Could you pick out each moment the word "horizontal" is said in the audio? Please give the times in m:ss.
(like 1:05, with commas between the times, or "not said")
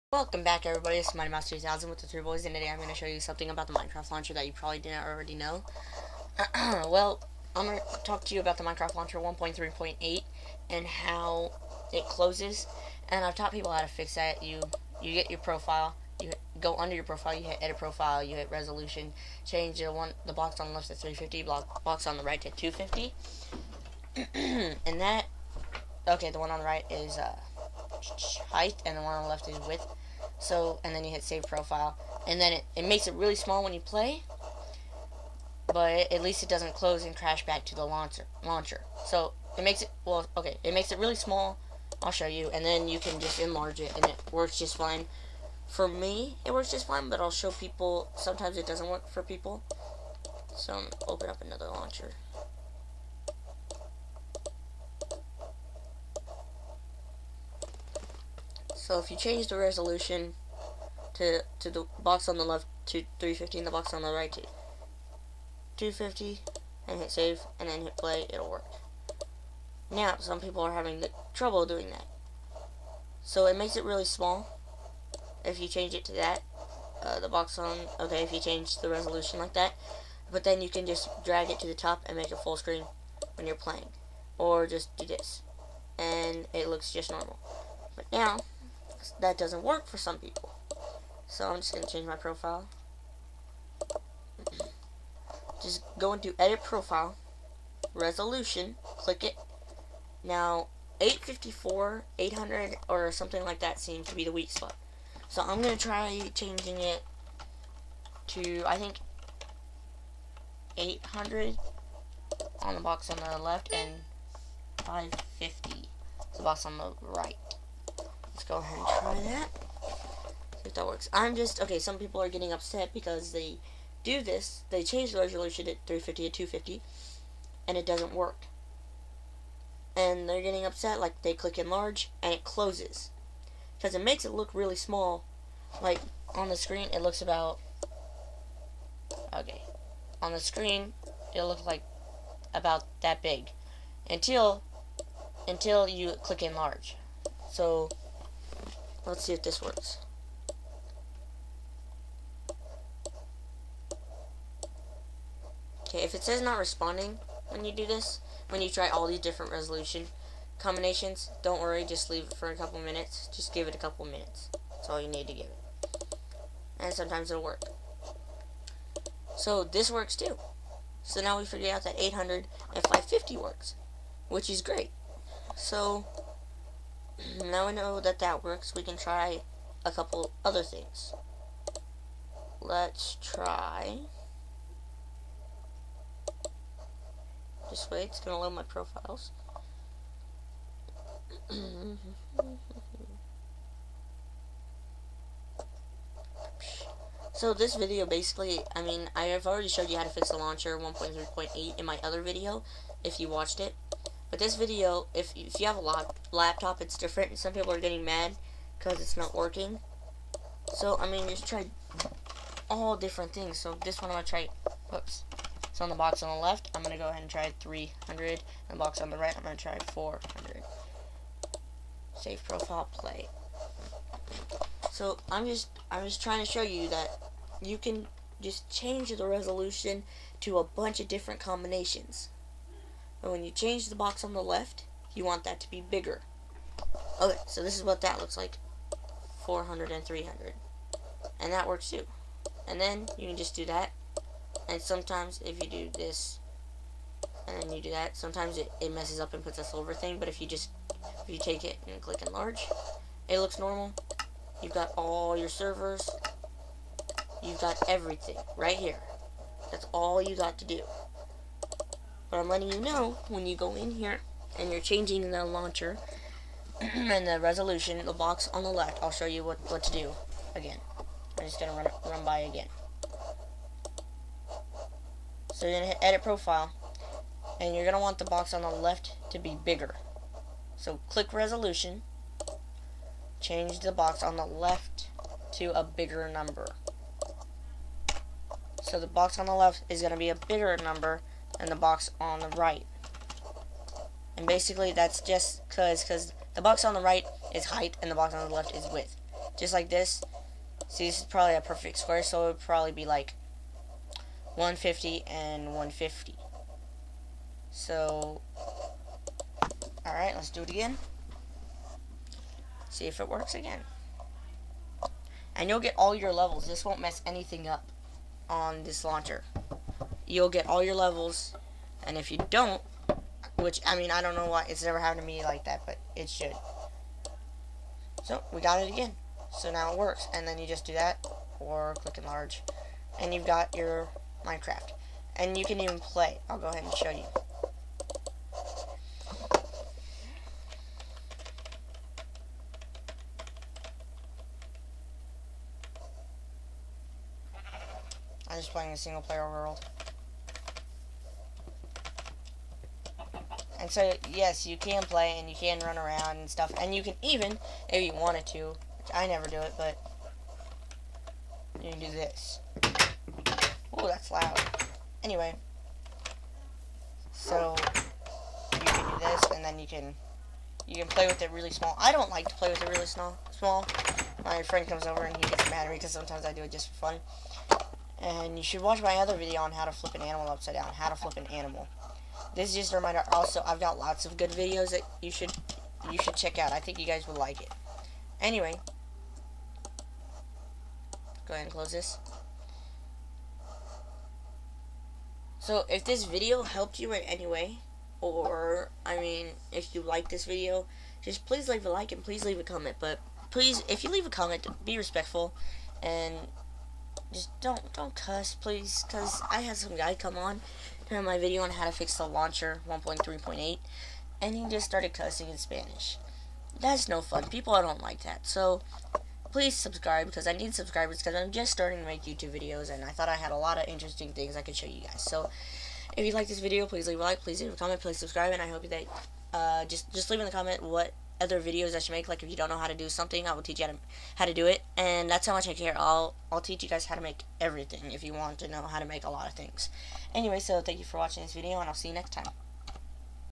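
not said.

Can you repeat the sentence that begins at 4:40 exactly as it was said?
So click resolution, change the box on the left to a bigger number.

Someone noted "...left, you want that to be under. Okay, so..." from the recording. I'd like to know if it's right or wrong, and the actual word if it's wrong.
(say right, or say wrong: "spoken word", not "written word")
wrong: "bigger", not "under".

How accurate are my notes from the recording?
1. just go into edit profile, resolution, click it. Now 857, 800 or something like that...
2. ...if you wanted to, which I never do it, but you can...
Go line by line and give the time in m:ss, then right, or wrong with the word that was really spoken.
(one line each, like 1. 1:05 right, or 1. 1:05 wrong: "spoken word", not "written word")
1. 1:35 wrong: "854", not "857"
2. 5:57 right.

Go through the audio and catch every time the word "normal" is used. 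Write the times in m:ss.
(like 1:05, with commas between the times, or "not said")
1:27, 4:13.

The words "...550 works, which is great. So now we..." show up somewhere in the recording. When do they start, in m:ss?
2:52.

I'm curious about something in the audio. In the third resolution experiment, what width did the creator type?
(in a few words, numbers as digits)
300.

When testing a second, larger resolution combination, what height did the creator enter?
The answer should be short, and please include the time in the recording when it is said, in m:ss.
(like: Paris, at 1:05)
550, at 1:54.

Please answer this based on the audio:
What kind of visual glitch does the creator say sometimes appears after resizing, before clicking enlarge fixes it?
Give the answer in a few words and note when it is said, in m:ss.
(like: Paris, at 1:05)
a silver thing, at 4:09.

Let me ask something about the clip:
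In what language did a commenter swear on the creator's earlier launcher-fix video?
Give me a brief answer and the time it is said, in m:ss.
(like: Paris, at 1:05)
Spanish, at 6:55.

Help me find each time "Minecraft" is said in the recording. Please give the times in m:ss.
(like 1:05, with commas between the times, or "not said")
0:03, 0:08, 5:34.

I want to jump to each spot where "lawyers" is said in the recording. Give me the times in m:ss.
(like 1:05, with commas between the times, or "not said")
not said.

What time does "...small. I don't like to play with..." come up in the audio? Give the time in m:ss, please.
6:11.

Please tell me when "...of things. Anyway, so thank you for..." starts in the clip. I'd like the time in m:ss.
7:19.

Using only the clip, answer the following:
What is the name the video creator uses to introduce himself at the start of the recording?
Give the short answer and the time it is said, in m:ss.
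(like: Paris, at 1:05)
Mighty Mouse 2000, at 0:01.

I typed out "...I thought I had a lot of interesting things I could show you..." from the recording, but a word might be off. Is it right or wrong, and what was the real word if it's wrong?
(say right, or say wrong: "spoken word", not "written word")
right.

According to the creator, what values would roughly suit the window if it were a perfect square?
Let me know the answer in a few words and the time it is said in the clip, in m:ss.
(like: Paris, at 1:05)
150 and 150, at 5:04.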